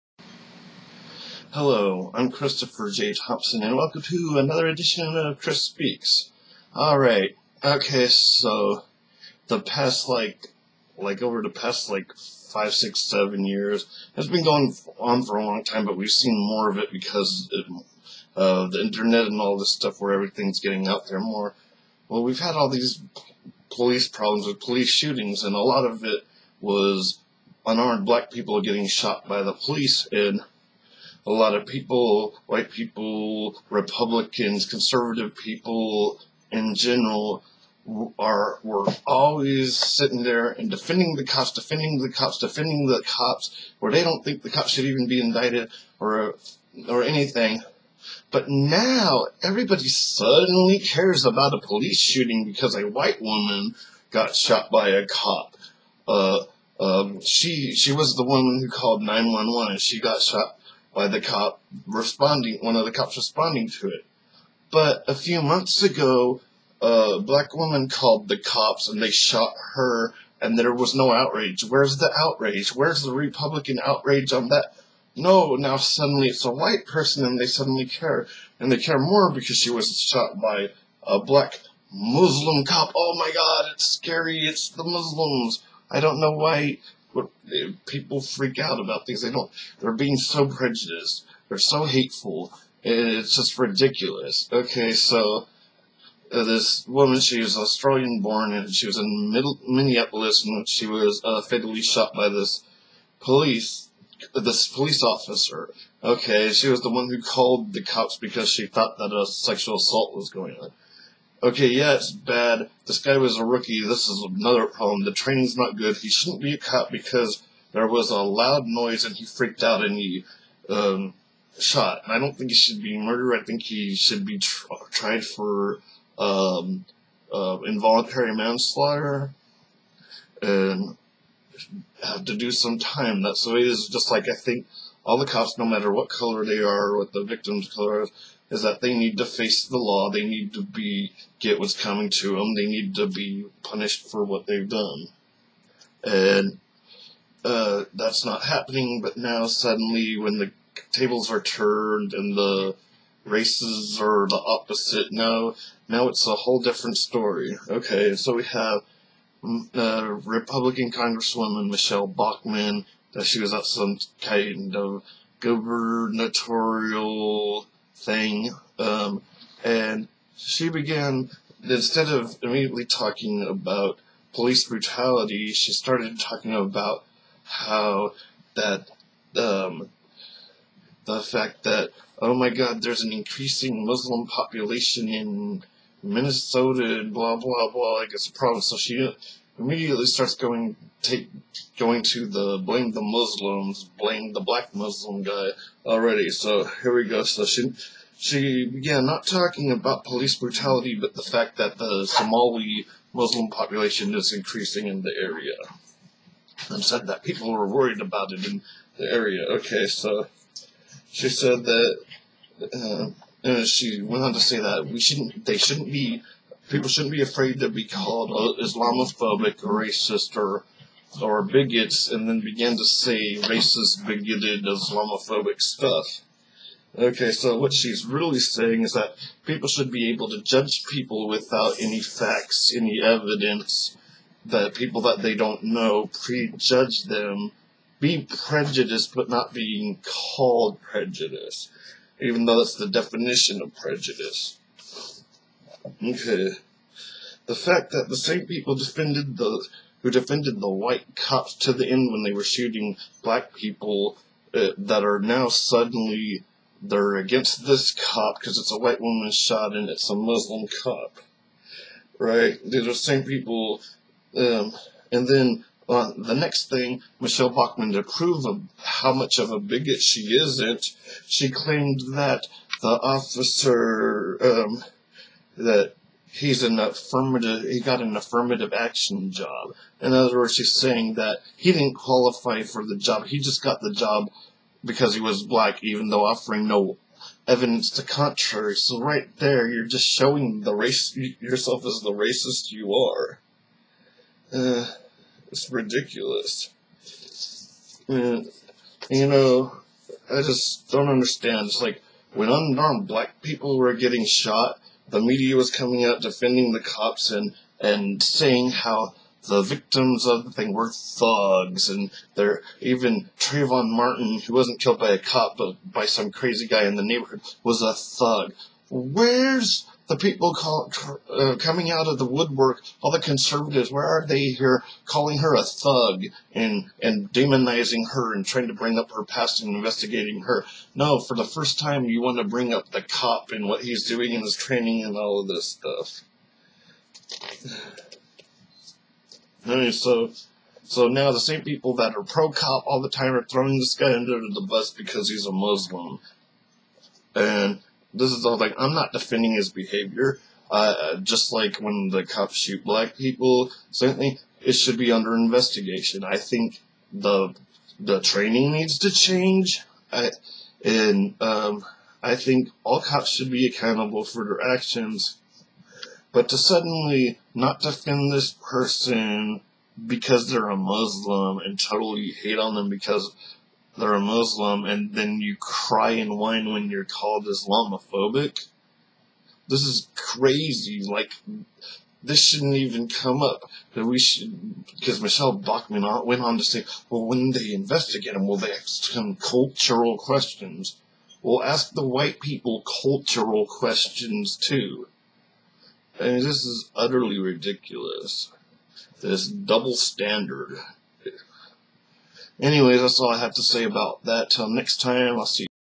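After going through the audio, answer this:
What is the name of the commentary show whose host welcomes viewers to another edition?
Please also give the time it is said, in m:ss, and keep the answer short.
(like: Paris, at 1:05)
Chris Speaks, at 0:05.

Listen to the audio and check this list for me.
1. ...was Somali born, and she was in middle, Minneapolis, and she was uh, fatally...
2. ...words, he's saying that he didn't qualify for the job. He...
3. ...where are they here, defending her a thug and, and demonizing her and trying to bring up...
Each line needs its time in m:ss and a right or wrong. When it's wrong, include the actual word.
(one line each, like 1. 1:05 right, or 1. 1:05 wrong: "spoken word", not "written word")
1. 1:37 wrong: "Australian", not "Somali"
2. 4:40 right
3. 5:23 wrong: "calling", not "defending".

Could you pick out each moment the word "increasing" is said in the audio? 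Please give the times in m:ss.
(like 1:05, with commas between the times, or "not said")
3:03, 3:24.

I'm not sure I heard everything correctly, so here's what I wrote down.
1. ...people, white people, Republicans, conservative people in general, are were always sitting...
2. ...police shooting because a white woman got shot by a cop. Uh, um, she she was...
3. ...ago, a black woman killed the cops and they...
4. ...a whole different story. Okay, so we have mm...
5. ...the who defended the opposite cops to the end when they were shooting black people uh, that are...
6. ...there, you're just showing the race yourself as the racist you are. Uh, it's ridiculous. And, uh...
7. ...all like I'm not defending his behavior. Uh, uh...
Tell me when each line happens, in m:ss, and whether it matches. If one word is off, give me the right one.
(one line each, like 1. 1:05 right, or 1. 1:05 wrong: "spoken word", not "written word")
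1. 0:31 right
2. 0:51 right
3. 1:05 wrong: "called", not "killed"
4. 2:36 right
5. 4:09 wrong: "white", not "opposite"
6. 4:49 right
7. 5:48 right.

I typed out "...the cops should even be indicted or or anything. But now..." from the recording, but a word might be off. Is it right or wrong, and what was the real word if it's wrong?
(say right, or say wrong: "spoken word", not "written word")
right.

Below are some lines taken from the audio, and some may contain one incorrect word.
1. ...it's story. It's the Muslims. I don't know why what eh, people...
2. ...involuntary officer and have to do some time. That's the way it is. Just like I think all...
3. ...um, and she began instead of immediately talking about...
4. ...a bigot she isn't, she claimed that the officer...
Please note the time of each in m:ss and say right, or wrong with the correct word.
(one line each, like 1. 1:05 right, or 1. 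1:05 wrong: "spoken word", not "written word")
1. 1:23 wrong: "scary", not "story"
2. 2:07 wrong: "manslaughter", not "officer"
3. 2:48 right
4. 4:29 right.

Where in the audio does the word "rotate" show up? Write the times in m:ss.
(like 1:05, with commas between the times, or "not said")
not said.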